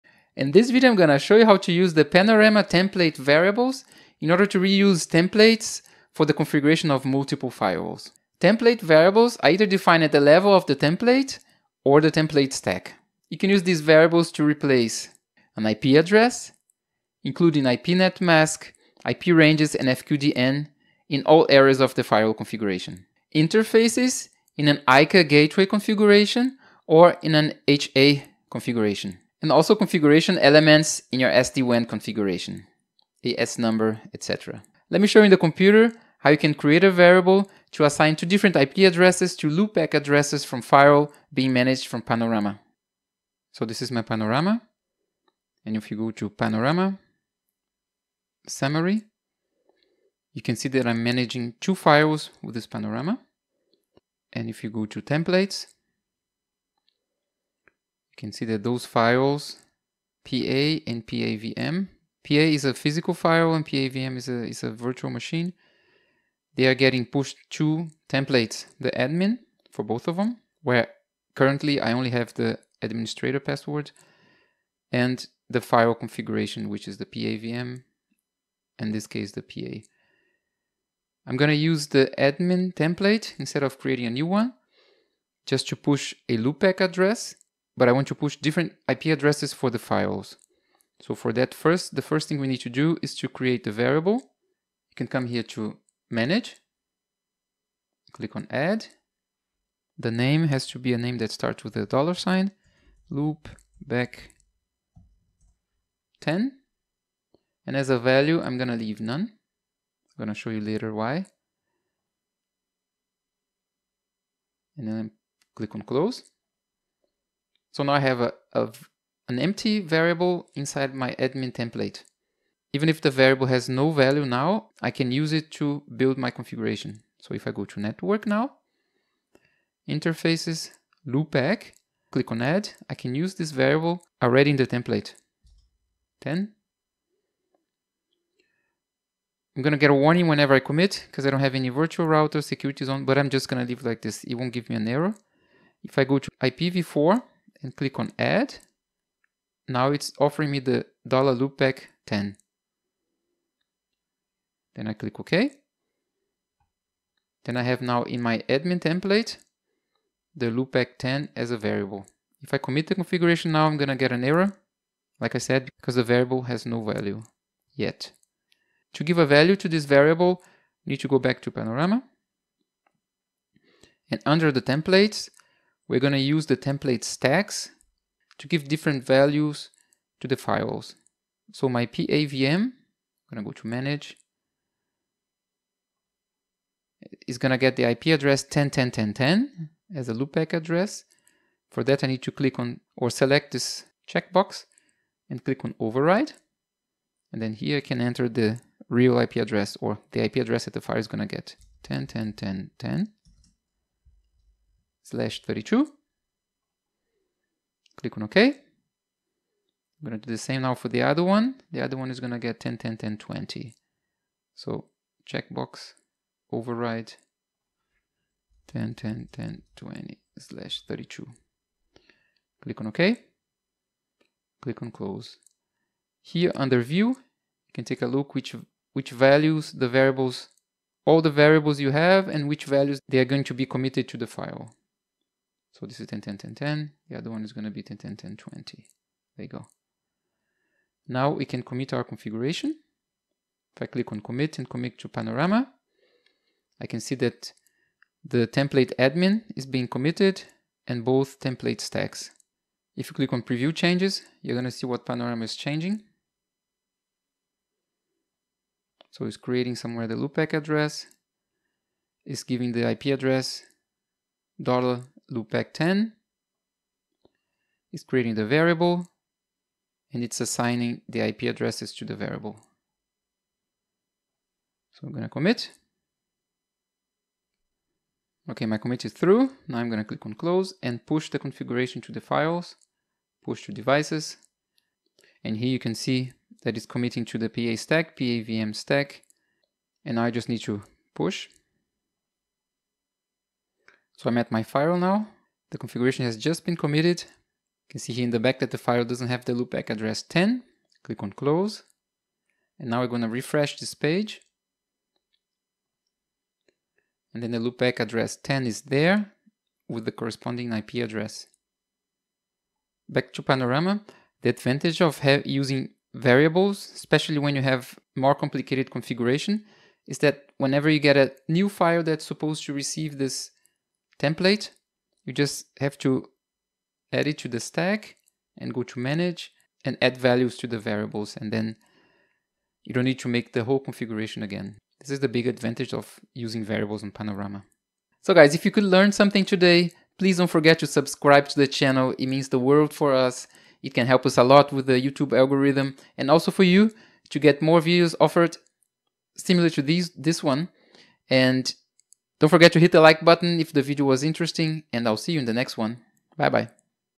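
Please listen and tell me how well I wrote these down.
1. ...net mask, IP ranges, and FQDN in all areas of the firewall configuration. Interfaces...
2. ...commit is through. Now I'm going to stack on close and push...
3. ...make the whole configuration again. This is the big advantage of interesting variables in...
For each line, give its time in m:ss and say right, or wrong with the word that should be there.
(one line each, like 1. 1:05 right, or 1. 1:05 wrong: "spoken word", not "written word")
1. 0:17 right
2. 4:38 wrong: "click", not "stack"
3. 5:33 wrong: "using", not "interesting".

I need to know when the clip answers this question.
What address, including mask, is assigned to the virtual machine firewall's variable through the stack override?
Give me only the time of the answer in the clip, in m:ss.
3:21.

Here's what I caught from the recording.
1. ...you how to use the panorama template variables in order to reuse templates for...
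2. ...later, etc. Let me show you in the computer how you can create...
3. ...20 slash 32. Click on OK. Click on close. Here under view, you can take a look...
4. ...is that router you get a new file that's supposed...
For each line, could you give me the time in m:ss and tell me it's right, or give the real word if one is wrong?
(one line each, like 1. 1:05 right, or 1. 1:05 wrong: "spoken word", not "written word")
1. 0:01 right
2. 0:33 wrong: "number", not "later"
3. 3:39 right
4. 5:20 wrong: "whenever", not "router".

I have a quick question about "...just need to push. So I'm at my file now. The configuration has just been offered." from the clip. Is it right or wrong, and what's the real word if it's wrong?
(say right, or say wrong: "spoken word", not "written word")
wrong: "committed", not "offered".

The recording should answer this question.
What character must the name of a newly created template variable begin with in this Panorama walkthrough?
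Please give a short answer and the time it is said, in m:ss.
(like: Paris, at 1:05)
dollar sign, at 1:41.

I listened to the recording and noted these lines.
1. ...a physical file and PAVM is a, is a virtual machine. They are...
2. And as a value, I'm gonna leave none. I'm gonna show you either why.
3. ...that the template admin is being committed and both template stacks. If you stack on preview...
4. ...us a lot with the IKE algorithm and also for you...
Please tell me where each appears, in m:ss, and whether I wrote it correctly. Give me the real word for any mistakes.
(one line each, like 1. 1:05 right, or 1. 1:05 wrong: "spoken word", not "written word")
1. 1:02 right
2. 1:47 wrong: "later", not "either"
3. 4:07 wrong: "click", not "stack"
4. 5:44 wrong: "YouTube", not "IKE".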